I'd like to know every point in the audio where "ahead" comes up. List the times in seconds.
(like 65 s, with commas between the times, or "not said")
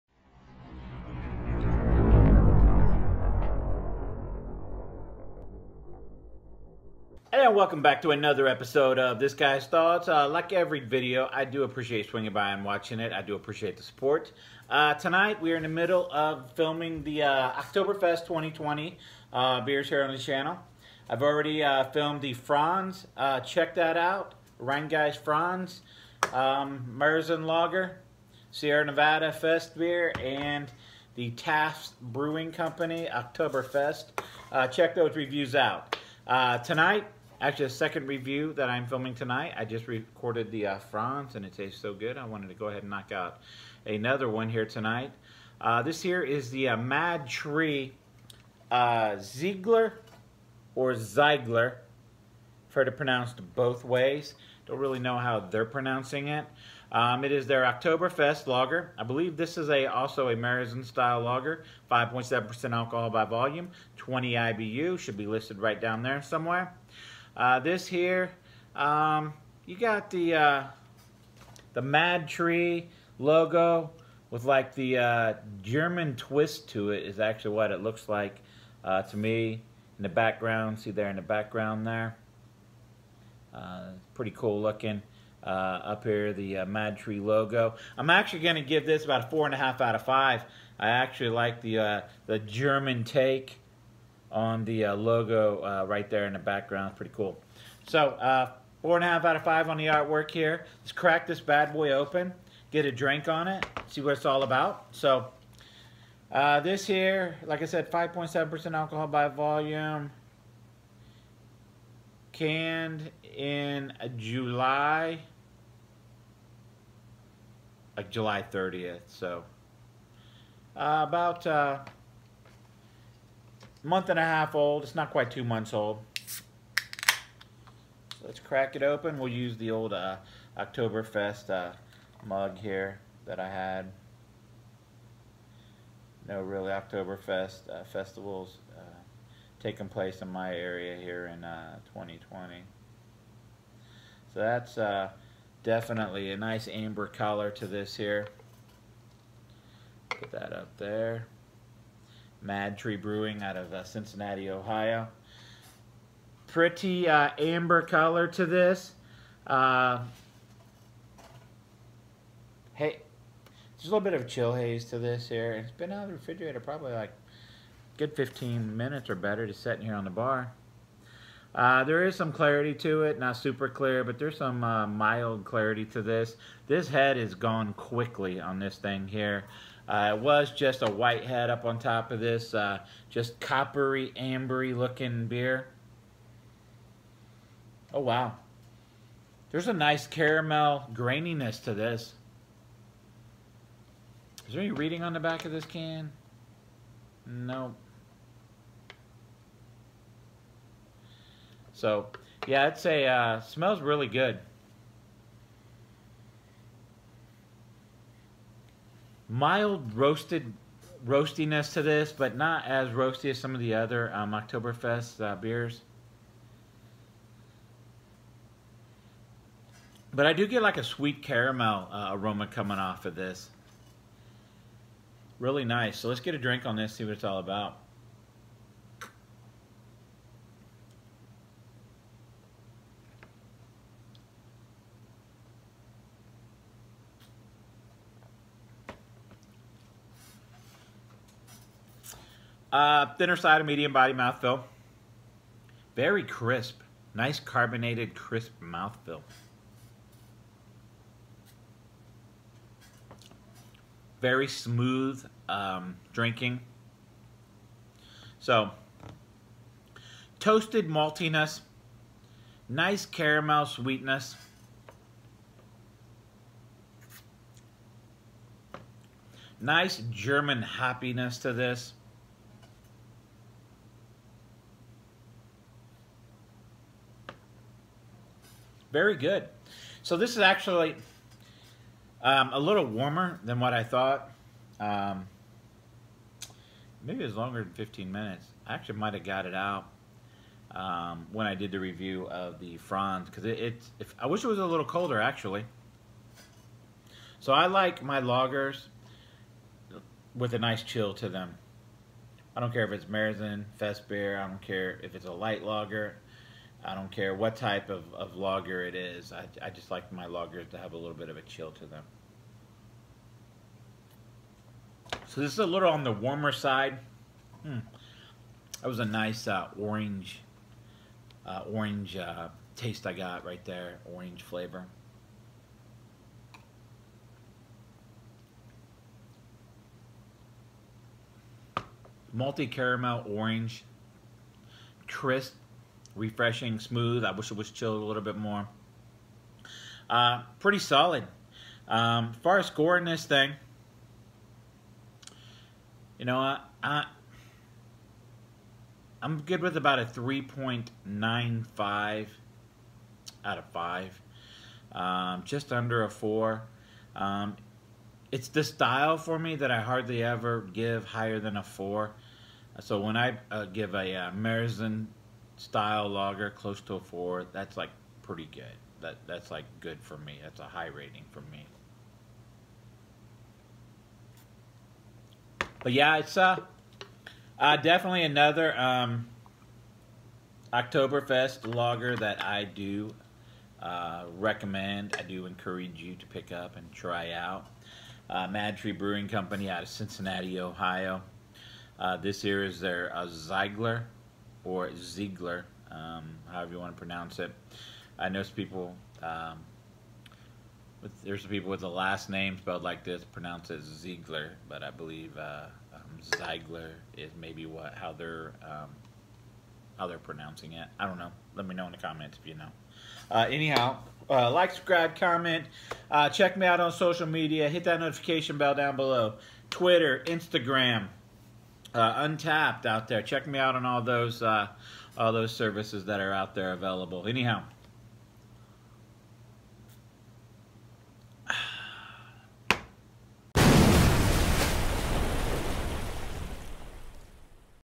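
42 s.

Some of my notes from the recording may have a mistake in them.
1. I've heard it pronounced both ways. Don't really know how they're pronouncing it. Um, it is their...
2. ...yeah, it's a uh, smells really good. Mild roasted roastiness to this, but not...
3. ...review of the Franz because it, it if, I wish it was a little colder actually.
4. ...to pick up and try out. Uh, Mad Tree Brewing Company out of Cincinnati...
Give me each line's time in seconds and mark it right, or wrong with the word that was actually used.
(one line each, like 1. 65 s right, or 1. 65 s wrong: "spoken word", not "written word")
1. 52 s right
2. 202 s right
3. 291 s right
4. 386 s right.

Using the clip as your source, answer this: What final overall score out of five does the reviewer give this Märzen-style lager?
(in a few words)
3.95.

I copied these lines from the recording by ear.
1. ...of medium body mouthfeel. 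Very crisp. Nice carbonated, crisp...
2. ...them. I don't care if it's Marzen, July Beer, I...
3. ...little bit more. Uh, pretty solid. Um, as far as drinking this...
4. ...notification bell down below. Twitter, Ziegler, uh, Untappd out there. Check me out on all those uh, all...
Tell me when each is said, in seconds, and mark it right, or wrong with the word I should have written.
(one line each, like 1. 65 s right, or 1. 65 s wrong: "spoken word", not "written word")
1. 243 s right
2. 301 s wrong: "Fest", not "July"
3. 338 s wrong: "scoring", not "drinking"
4. 417 s wrong: "Instagram", not "Ziegler".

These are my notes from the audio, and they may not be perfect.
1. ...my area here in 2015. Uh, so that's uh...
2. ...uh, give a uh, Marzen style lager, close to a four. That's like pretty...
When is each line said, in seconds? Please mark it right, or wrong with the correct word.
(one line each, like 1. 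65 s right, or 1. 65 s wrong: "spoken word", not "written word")
1. 140 s wrong: "2020", not "2015"
2. 363 s right.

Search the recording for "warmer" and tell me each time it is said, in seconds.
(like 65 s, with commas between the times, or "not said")
282 s, 316 s.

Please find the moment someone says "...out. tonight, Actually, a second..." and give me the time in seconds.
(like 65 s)
35 s.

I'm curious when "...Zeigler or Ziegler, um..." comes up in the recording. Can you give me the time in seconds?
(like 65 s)
393 s.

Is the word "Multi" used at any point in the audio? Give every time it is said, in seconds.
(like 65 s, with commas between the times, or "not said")
332 s.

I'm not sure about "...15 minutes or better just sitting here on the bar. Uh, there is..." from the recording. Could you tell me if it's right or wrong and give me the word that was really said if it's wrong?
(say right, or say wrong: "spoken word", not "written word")
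right.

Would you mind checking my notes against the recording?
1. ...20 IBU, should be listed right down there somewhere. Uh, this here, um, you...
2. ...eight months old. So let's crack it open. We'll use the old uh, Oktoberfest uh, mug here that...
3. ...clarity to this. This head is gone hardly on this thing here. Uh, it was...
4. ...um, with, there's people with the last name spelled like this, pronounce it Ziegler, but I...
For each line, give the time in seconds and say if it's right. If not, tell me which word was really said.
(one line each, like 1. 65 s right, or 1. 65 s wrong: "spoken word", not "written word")
1. 63 s right
2. 125 s wrong: "two", not "eight"
3. 175 s wrong: "quickly", not "hardly"
4. 399 s right.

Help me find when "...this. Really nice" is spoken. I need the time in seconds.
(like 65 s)
223 s.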